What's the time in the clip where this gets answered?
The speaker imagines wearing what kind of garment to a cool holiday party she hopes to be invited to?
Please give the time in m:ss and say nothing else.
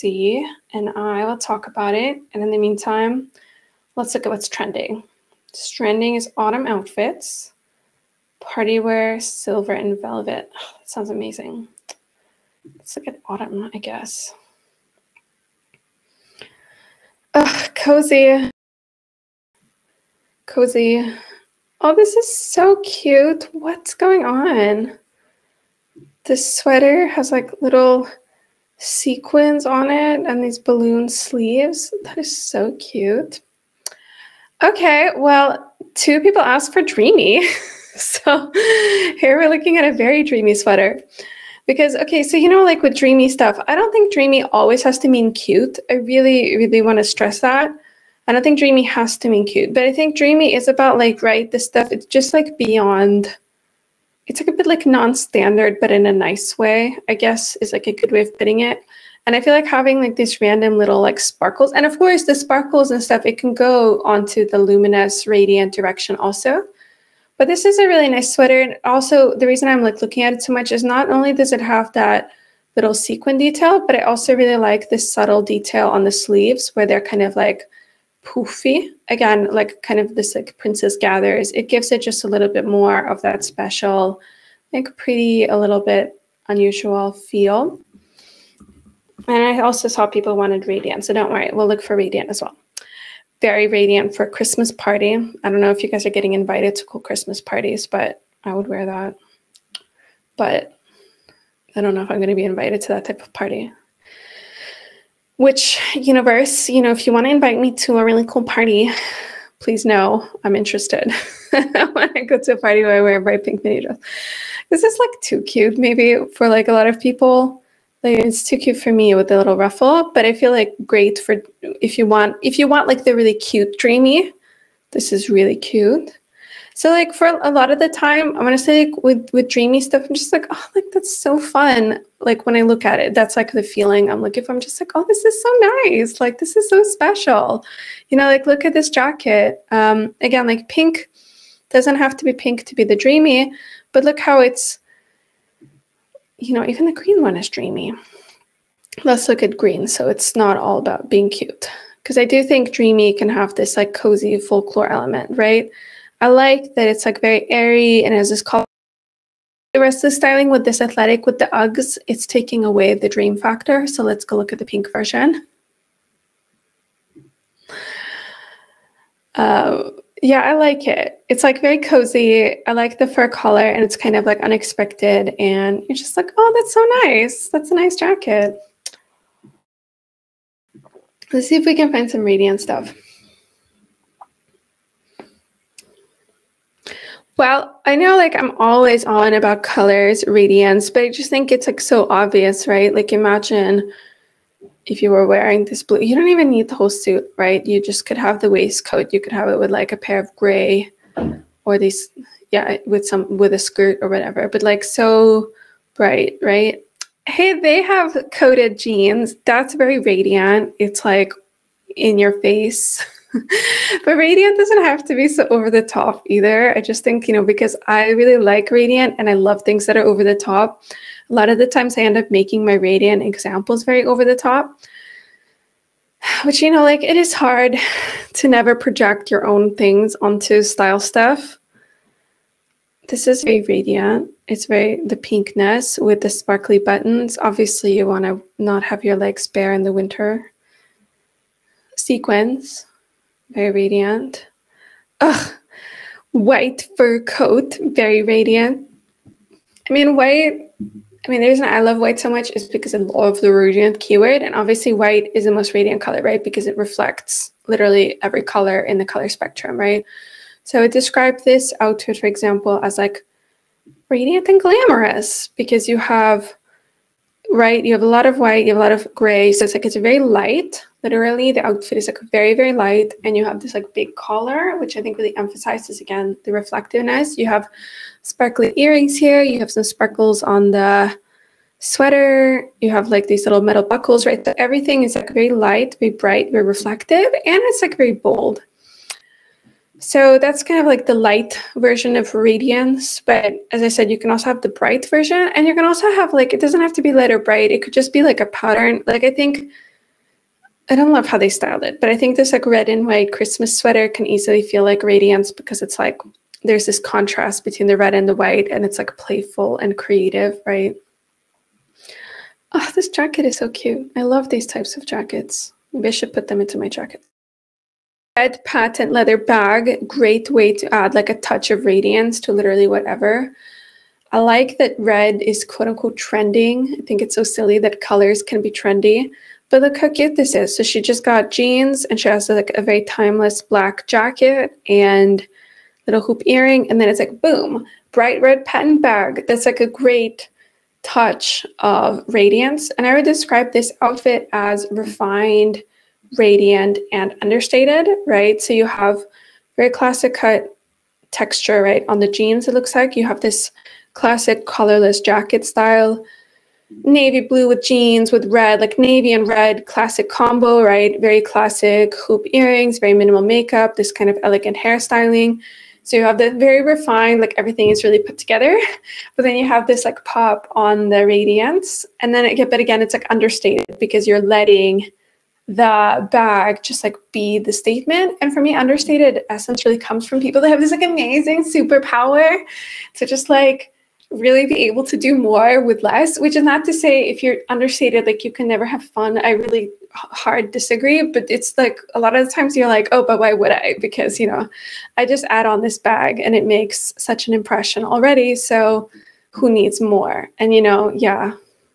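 1:53.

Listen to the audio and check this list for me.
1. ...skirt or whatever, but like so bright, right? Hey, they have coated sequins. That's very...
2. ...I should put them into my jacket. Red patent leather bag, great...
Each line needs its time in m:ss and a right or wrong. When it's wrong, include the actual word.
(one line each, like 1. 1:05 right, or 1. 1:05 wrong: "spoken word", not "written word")
1. 3:23 wrong: "jeans", not "sequins"
2. 5:16 right.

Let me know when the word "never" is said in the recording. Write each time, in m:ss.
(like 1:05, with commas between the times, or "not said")
3:48, 6:28.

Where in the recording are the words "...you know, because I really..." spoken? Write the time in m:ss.
3:37.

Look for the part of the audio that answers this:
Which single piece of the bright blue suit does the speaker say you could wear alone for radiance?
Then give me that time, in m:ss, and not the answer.
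3:18.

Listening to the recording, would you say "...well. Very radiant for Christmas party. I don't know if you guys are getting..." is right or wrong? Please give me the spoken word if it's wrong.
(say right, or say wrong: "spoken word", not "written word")
right.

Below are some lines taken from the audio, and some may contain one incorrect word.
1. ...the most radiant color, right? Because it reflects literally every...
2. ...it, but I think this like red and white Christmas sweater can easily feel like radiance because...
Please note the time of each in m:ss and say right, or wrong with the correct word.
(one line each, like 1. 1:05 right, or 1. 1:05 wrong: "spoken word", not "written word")
1. 4:15 right
2. 5:01 right.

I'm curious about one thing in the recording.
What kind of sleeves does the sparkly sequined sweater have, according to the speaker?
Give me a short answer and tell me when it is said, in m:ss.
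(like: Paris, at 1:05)
Balloon sleeves, at 0:30.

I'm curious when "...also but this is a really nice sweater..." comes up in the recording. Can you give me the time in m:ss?
1:06.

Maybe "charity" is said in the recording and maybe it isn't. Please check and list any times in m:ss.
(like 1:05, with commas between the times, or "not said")
not said.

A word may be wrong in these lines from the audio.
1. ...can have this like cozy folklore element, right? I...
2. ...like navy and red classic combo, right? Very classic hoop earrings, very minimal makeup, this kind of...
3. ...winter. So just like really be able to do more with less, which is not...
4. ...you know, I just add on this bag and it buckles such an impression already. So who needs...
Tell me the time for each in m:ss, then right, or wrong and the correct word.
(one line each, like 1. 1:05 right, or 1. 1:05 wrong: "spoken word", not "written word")
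1. 2:33 right
2. 5:58 right
3. 6:21 wrong: "superpower", not "winter"
4. 6:34 wrong: "makes", not "buckles".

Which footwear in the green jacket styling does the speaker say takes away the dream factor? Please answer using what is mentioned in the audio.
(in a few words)
Uggs.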